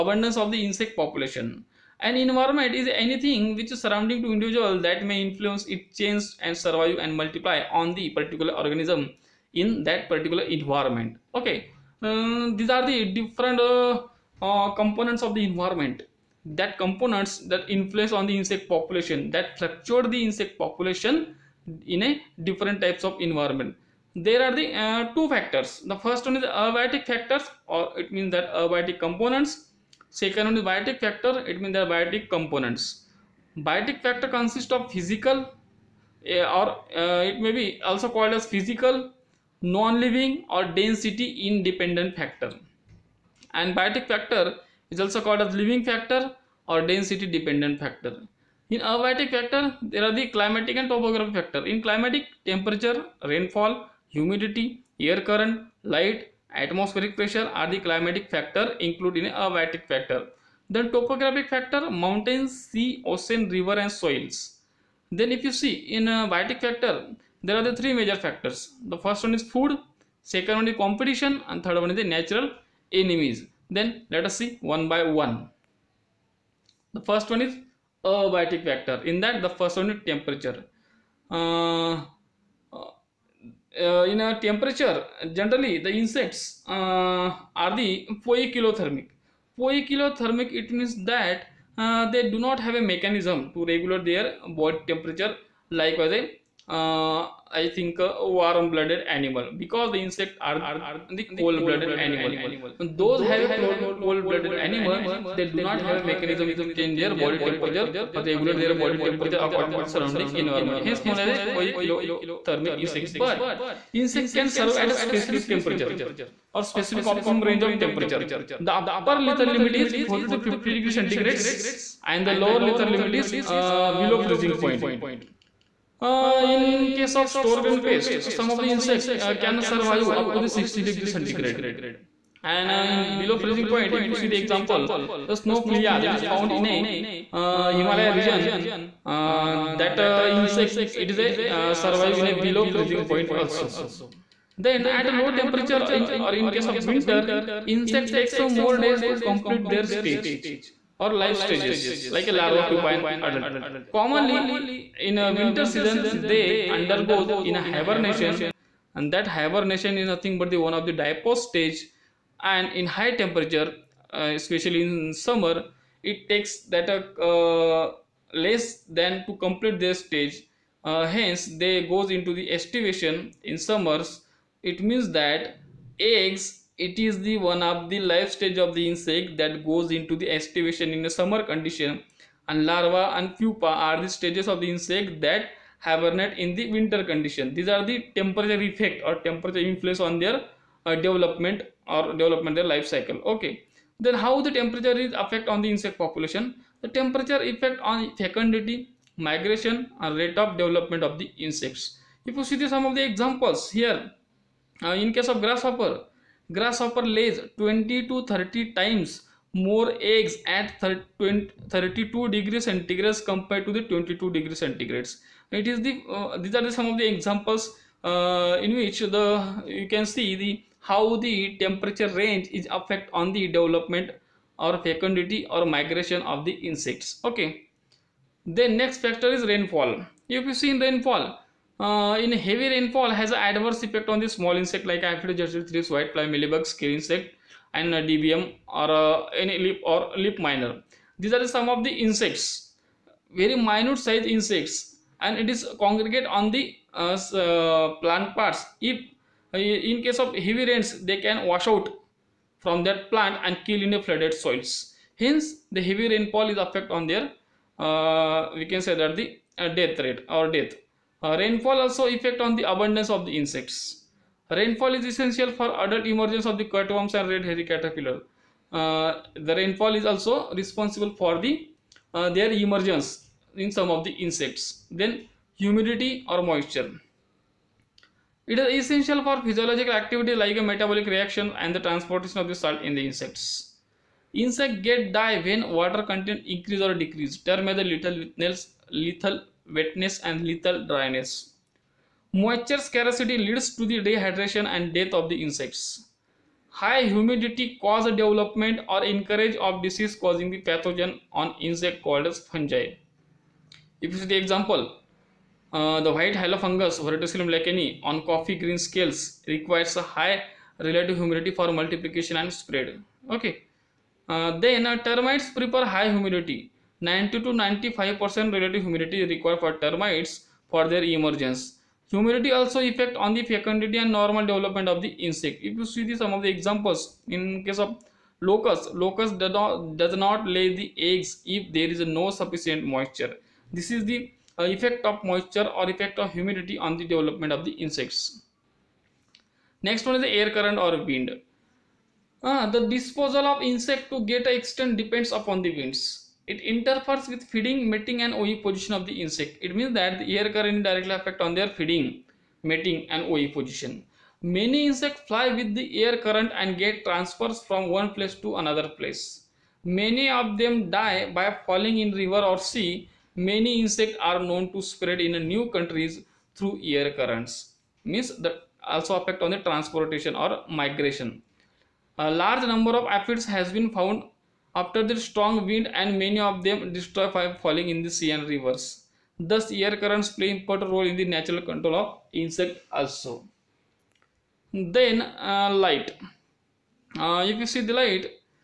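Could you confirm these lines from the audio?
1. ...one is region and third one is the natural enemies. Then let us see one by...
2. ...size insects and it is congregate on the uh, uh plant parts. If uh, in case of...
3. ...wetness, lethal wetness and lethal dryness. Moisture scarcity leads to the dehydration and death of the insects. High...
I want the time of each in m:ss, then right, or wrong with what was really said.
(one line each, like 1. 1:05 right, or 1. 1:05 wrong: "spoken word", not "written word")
1. 1:10 wrong: "competition", not "region"
2. 4:03 right
3. 4:48 right.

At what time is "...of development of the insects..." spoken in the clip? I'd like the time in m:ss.
3:20.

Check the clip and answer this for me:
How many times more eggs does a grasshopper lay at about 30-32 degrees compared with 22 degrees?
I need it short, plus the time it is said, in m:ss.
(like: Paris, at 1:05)
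20 to 30, at 3:27.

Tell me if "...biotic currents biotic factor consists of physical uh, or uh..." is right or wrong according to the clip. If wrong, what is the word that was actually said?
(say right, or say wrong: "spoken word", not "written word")
wrong: "components", not "currents".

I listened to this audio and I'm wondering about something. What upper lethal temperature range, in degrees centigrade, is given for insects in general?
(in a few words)
40 to 50.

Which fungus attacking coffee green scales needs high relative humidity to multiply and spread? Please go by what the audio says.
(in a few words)
Verticillium lecanii.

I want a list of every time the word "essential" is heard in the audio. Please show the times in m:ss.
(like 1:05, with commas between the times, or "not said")
4:25, 4:38.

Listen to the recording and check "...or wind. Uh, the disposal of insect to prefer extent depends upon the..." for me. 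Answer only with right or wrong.
wrong.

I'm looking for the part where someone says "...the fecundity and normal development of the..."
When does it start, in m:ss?
5:23.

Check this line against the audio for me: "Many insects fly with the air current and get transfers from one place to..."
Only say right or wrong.
right.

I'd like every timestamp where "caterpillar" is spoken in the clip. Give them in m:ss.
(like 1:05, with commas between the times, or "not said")
4:27.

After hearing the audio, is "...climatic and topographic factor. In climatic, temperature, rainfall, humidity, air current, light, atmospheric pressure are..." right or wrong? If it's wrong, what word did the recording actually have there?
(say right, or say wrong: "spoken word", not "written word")
right.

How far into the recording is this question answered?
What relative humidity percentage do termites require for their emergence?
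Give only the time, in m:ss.
5:17.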